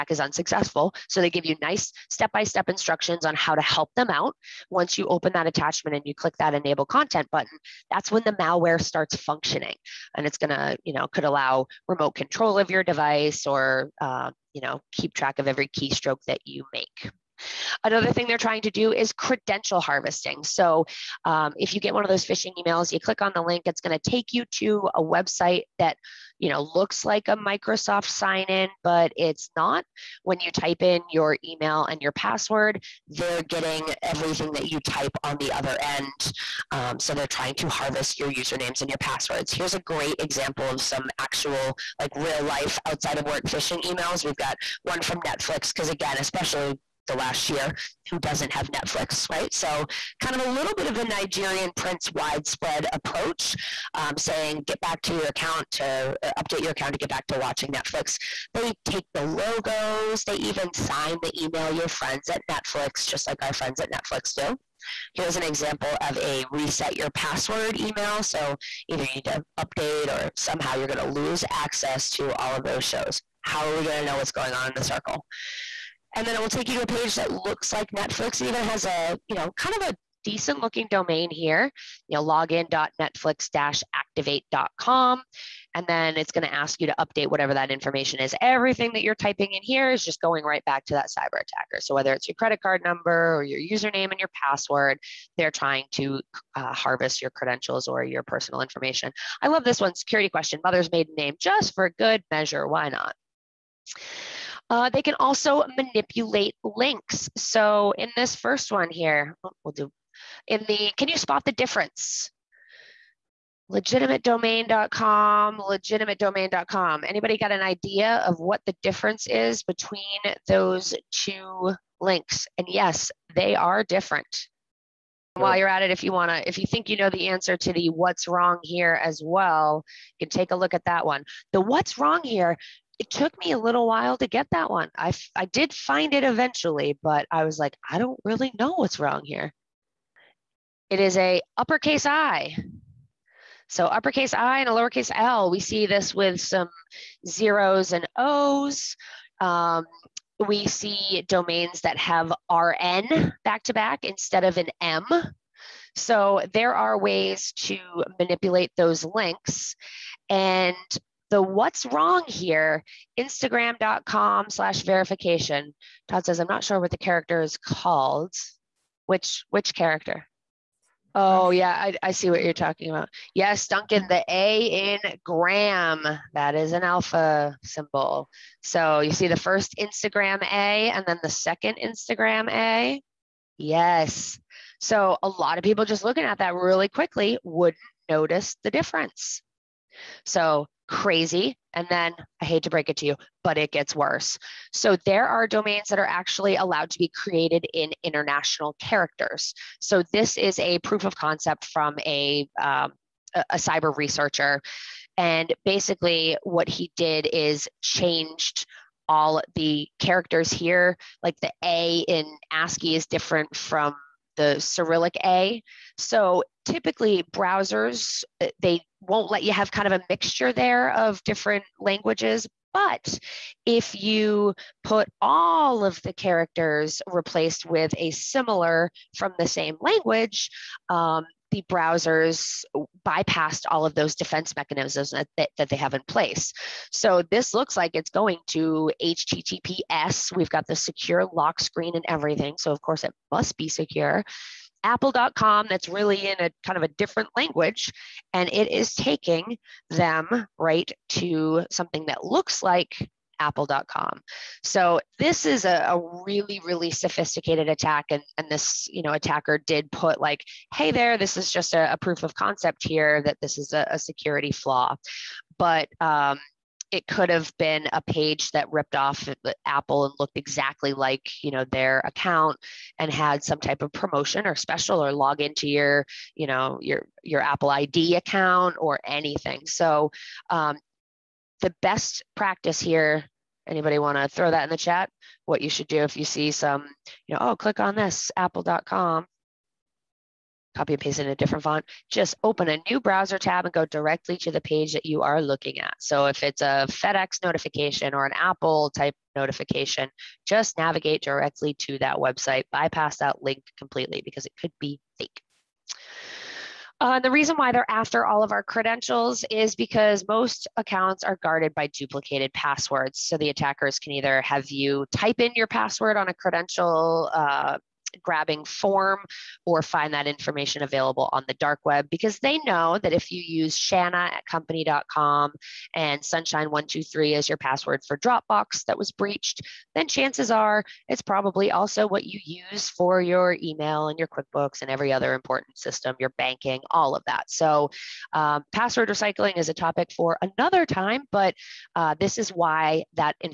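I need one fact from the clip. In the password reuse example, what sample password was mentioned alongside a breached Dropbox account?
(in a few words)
sunshine123.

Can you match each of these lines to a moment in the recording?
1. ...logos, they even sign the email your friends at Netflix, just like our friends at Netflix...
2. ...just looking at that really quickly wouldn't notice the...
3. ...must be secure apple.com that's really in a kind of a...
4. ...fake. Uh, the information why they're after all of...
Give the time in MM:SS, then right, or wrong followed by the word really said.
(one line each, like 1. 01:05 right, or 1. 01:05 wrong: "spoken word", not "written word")
1. 00:59 right
2. 03:05 right
3. 04:03 right
4. 05:05 wrong: "reason", not "information".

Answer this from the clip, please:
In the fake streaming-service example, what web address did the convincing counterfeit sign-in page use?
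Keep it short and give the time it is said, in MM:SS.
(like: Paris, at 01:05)
login.netflix-activate.com, at 01:22.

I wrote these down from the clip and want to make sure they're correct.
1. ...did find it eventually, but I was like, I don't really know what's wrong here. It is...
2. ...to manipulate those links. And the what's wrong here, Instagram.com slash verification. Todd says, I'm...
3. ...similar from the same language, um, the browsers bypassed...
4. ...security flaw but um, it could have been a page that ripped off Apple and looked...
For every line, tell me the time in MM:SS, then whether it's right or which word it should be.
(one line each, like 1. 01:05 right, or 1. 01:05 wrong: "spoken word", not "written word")
1. 02:15 right
2. 02:37 right
3. 03:48 right
4. 04:23 right.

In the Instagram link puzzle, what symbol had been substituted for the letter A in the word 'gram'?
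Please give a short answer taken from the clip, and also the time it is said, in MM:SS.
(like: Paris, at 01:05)
Alpha symbol, at 02:56.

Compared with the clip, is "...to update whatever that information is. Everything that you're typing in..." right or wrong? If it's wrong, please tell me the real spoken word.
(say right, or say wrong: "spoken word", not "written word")
right.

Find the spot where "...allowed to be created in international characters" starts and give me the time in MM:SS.
03:16.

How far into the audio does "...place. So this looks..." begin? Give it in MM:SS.
03:56.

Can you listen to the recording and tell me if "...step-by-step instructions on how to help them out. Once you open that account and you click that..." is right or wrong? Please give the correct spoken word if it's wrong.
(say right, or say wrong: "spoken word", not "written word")
wrong: "attachment", not "account".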